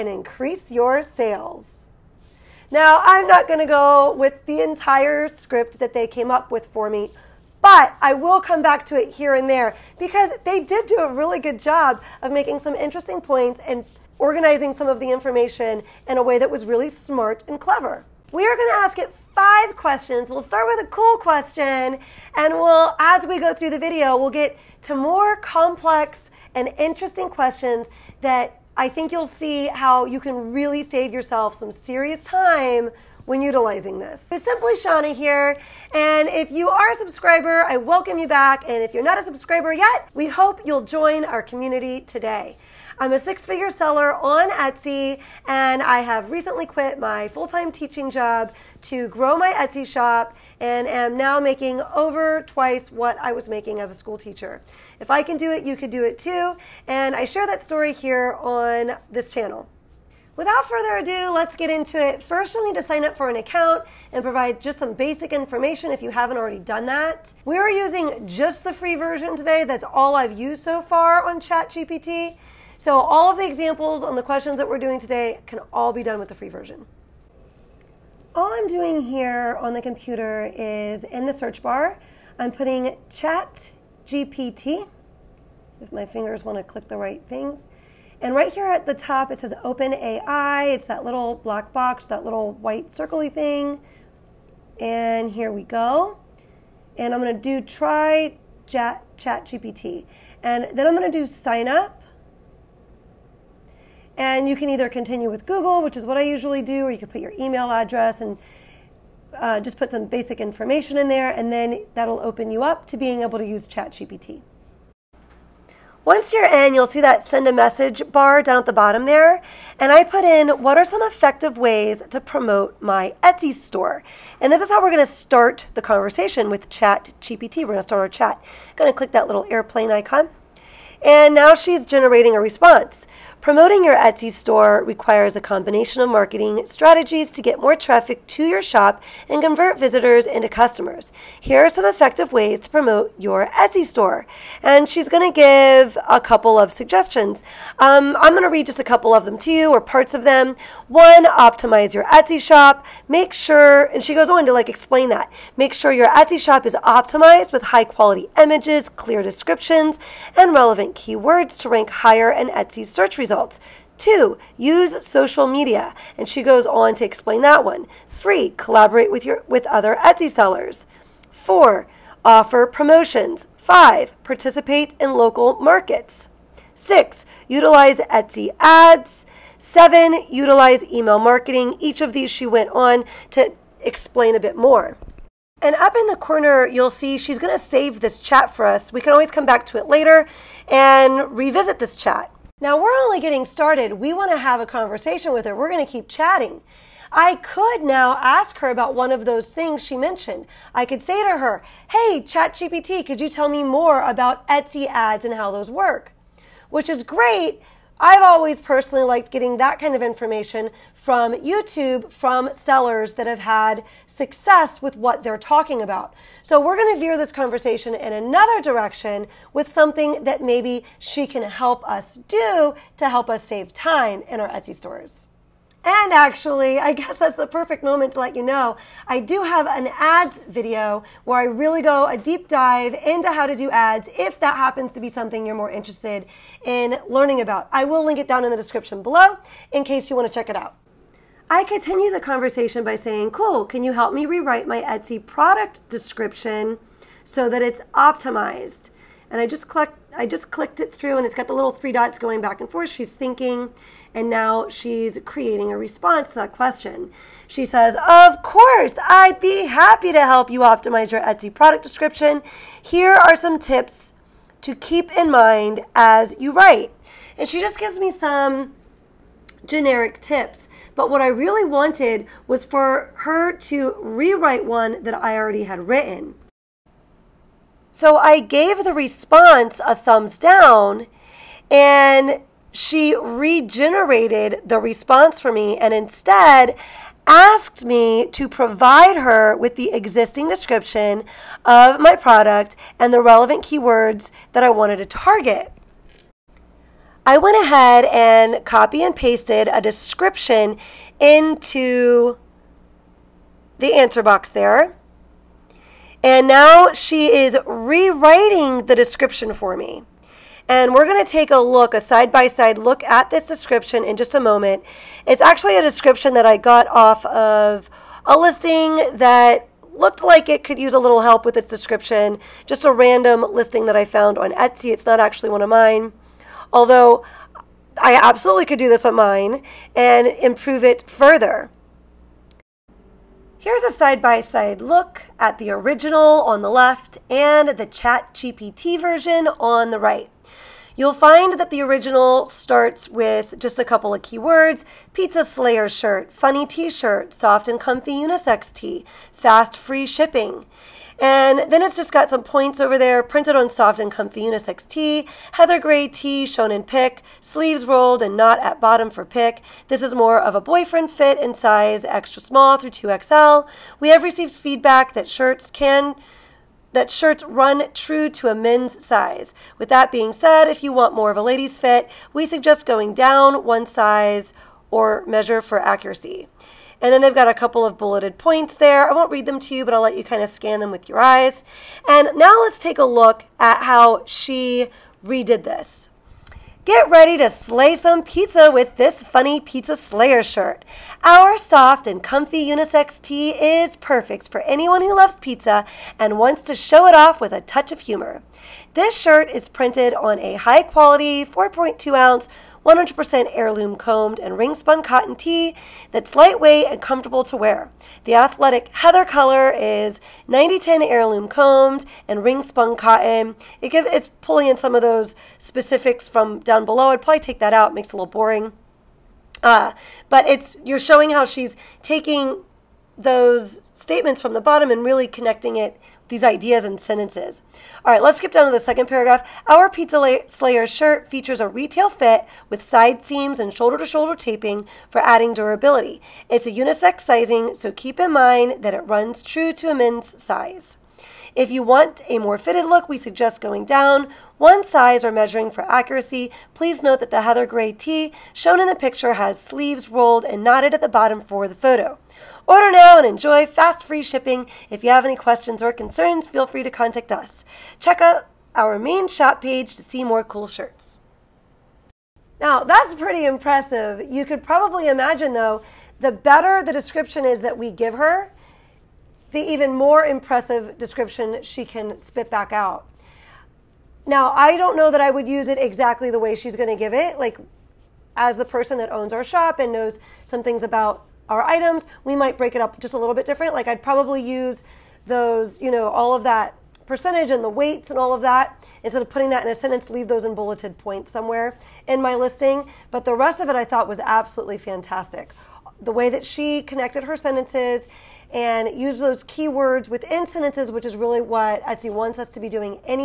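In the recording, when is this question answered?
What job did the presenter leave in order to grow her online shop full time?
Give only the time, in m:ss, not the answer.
0:47.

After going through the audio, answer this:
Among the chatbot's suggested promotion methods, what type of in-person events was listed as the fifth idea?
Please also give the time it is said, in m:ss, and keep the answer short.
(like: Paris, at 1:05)
local markets, at 2:55.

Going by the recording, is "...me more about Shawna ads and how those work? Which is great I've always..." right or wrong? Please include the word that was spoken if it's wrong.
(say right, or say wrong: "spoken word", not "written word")
wrong: "Etsy", not "Shawna".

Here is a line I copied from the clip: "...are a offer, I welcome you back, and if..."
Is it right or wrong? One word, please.
wrong.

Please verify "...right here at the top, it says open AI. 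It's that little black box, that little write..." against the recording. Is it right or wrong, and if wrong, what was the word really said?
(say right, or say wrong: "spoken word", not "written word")
wrong: "white", not "write".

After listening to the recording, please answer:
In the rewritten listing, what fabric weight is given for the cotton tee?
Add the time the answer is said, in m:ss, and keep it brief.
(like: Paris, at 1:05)
4.2 ounce, at 6:41.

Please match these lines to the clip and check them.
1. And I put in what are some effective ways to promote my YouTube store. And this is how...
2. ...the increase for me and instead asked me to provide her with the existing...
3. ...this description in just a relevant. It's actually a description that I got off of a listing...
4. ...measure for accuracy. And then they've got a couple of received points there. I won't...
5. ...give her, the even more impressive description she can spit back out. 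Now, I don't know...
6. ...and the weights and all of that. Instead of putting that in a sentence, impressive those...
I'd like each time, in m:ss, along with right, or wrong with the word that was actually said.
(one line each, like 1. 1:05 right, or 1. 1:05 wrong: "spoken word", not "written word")
1. 1:59 wrong: "Etsy", not "YouTube"
2. 4:44 wrong: "response", not "increase"
3. 5:13 wrong: "moment", not "relevant"
4. 6:15 wrong: "bulleted", not "received"
5. 7:47 right
6. 8:07 wrong: "leave", not "impressive".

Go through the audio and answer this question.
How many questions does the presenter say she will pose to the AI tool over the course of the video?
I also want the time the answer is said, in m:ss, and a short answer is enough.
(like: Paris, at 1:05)
5, at 0:19.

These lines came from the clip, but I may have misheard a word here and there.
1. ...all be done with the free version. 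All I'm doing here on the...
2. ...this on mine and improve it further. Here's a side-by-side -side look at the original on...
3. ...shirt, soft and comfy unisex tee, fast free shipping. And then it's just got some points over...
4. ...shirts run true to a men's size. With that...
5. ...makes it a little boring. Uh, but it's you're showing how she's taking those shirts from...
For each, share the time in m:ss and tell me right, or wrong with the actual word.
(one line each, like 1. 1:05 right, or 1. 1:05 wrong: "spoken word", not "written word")
1. 1:15 right
2. 5:28 right
3. 5:46 right
4. 6:07 right
5. 6:57 wrong: "statements", not "shirts".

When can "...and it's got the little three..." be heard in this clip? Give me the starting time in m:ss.
4:11.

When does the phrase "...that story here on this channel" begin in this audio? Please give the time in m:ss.
0:57.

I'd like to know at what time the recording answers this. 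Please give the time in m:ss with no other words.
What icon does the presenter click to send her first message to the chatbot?
2:09.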